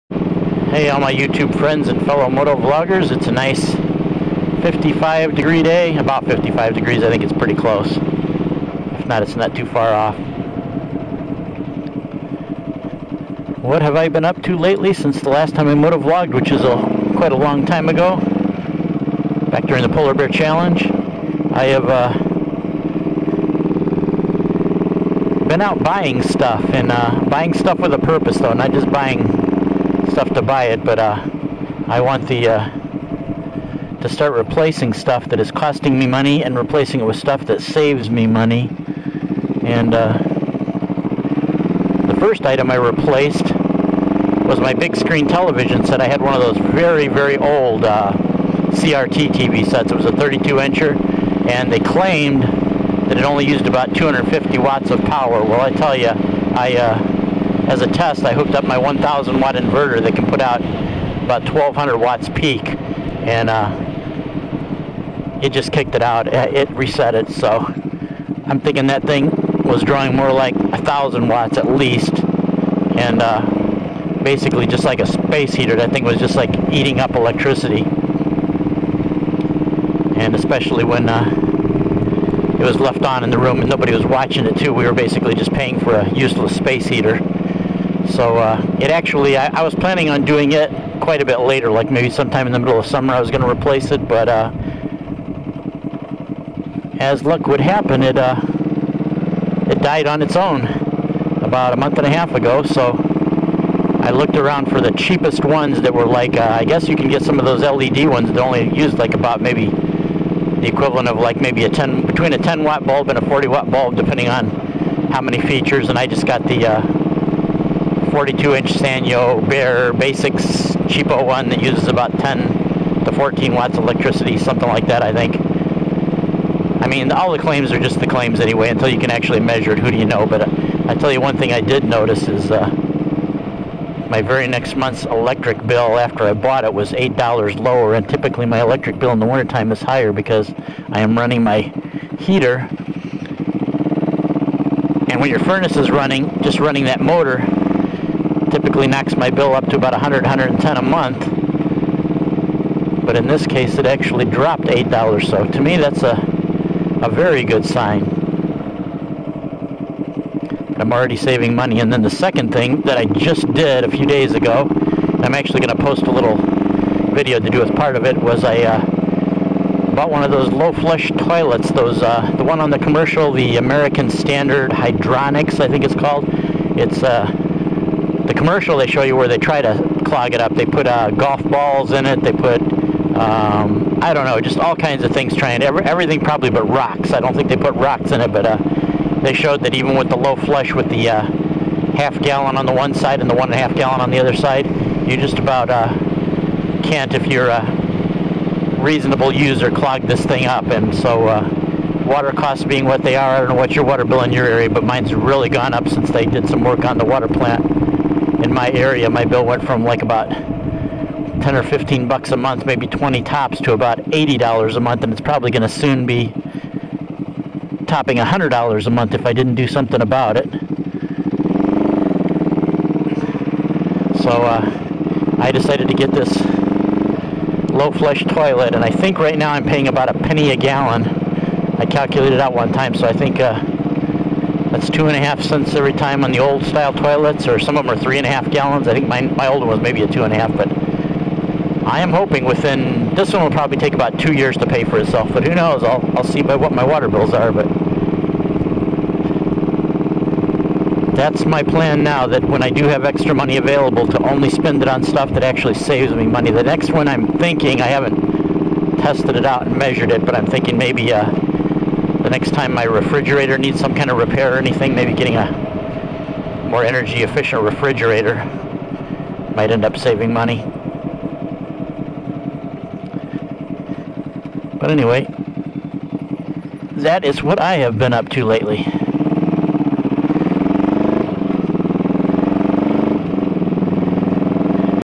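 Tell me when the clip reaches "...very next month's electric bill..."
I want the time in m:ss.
2:14.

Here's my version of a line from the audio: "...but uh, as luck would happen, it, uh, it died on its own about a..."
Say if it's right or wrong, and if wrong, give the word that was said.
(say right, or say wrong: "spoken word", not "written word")
right.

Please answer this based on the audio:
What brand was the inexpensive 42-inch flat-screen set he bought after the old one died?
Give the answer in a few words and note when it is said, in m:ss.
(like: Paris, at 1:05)
Sanyo, at 1:58.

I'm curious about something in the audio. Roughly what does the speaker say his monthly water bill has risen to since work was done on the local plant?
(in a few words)
$80.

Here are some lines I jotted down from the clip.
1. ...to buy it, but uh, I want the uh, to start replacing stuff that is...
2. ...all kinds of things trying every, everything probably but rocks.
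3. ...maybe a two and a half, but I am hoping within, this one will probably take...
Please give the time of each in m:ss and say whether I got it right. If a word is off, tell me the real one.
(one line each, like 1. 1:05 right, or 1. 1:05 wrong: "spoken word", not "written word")
1. 0:30 right
2. 3:04 right
3. 3:59 right.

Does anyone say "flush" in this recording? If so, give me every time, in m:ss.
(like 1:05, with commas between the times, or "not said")
2:50, 3:10, 3:47.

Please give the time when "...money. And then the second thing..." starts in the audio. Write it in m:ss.
2:41.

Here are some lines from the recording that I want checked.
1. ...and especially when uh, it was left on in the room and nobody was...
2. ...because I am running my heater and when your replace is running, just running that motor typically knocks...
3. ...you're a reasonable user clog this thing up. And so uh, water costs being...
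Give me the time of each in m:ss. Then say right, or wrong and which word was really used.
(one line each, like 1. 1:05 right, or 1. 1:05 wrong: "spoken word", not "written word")
1. 1:20 right
2. 2:20 wrong: "furnace", not "replace"
3. 3:17 right.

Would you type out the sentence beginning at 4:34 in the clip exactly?
But anyway, that is what I have been up to lately.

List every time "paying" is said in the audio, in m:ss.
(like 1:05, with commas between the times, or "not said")
1:25, 3:49.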